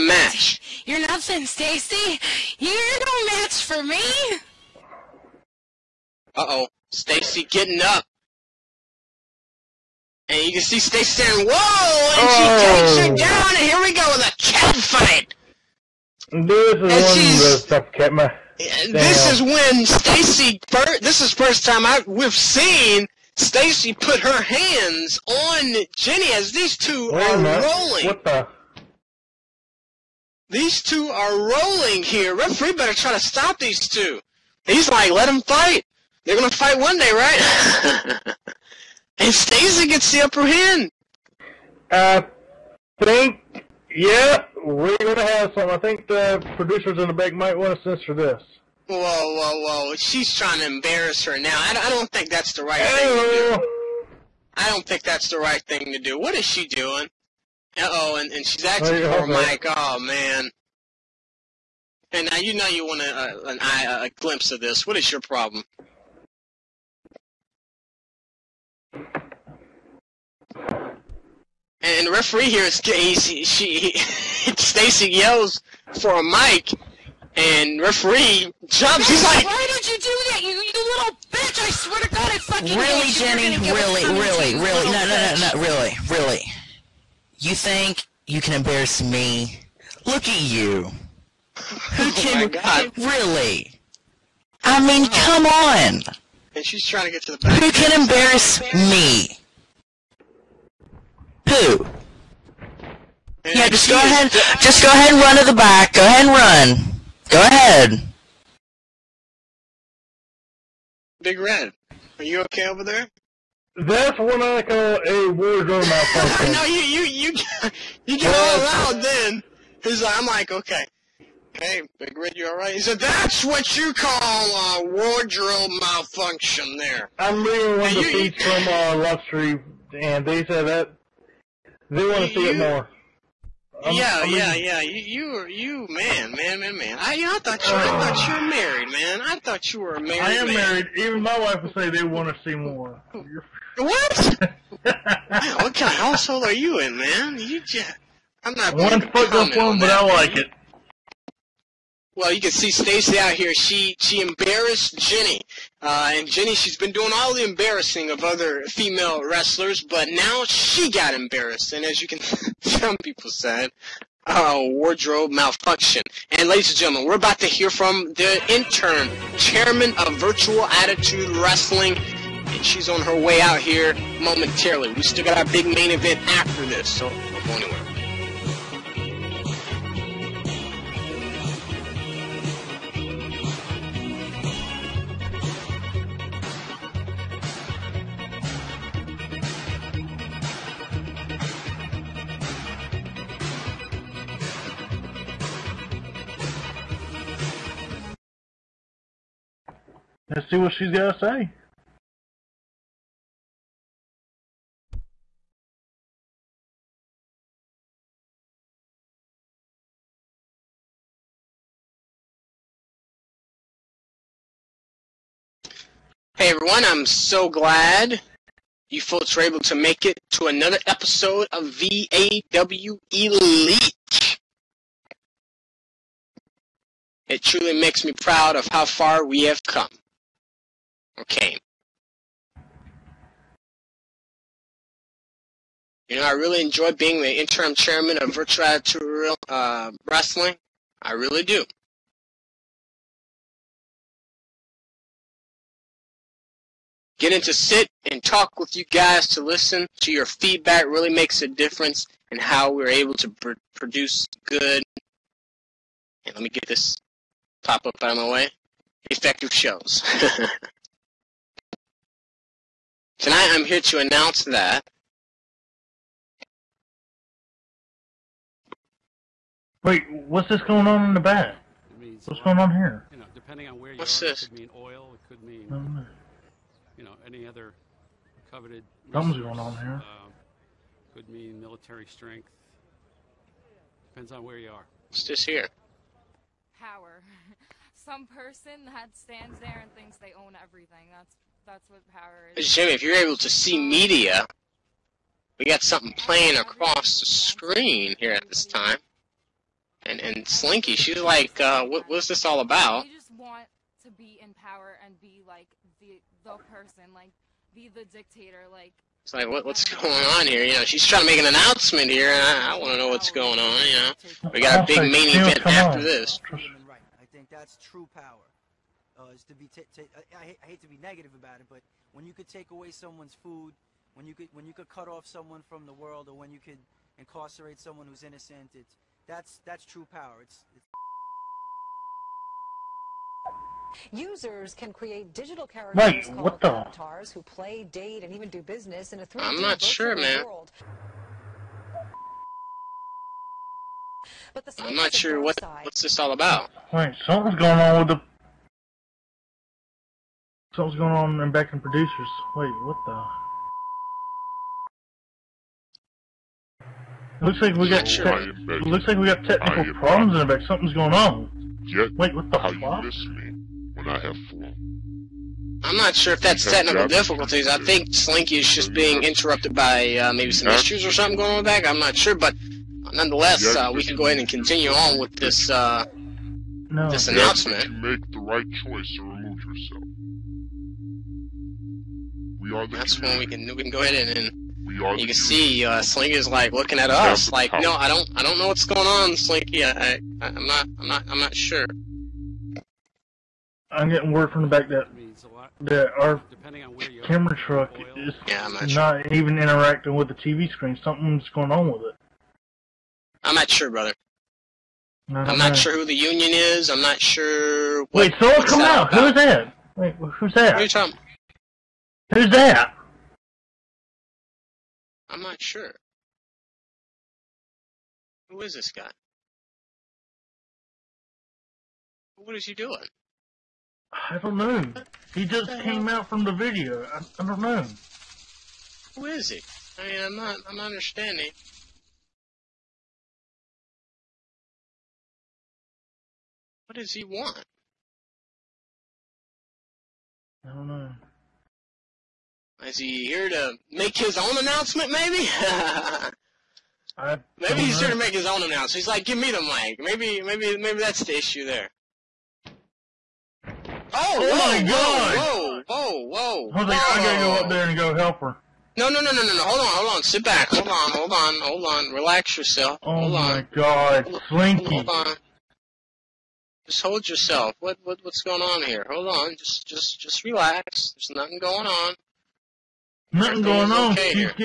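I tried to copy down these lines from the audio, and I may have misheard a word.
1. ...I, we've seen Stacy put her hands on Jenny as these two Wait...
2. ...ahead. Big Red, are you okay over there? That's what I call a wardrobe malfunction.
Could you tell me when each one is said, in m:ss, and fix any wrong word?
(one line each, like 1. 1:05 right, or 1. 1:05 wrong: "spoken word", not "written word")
1. 0:21 right
2. 1:47 right.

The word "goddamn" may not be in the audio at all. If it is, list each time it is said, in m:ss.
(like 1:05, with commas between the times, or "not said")
not said.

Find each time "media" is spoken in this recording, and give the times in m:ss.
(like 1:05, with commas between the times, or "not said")
4:53.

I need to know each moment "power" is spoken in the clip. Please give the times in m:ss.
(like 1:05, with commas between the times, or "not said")
4:46, 4:52, 5:04, 5:18, 5:30.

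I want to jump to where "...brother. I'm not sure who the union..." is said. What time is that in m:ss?
6:43.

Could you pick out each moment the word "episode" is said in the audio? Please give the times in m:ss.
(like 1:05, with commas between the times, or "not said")
3:40.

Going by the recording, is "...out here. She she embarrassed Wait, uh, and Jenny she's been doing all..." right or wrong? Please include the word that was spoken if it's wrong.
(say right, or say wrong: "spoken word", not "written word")
wrong: "Jenny", not "Wait".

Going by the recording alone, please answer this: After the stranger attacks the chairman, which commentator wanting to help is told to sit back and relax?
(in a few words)
Jose.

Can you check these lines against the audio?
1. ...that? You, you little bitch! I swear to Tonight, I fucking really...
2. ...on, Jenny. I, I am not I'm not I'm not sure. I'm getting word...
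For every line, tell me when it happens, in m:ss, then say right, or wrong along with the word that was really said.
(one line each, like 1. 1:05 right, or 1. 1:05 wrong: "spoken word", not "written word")
1. 1:20 wrong: "God", not "Tonight"
2. 6:29 wrong: "Slinky", not "Jenny".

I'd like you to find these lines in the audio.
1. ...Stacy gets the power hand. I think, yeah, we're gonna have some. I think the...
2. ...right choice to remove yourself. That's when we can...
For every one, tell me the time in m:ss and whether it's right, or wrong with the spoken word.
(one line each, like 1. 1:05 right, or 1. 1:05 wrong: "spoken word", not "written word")
1. 0:39 wrong: "upper", not "power"
2. 6:18 right.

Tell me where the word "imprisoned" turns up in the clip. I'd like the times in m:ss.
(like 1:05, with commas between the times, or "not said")
not said.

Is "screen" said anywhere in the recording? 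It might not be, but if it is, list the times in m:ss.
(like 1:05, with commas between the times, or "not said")
4:57, 6:40.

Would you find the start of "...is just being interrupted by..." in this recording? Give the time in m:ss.
6:08.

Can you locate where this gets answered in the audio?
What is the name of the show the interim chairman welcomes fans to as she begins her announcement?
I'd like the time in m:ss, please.
3:41.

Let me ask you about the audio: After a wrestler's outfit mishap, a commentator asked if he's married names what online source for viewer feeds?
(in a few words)
Love Street.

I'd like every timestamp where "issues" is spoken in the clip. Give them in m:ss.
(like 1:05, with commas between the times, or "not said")
6:10, 7:31.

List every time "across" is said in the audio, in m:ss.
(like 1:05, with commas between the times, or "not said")
4:56.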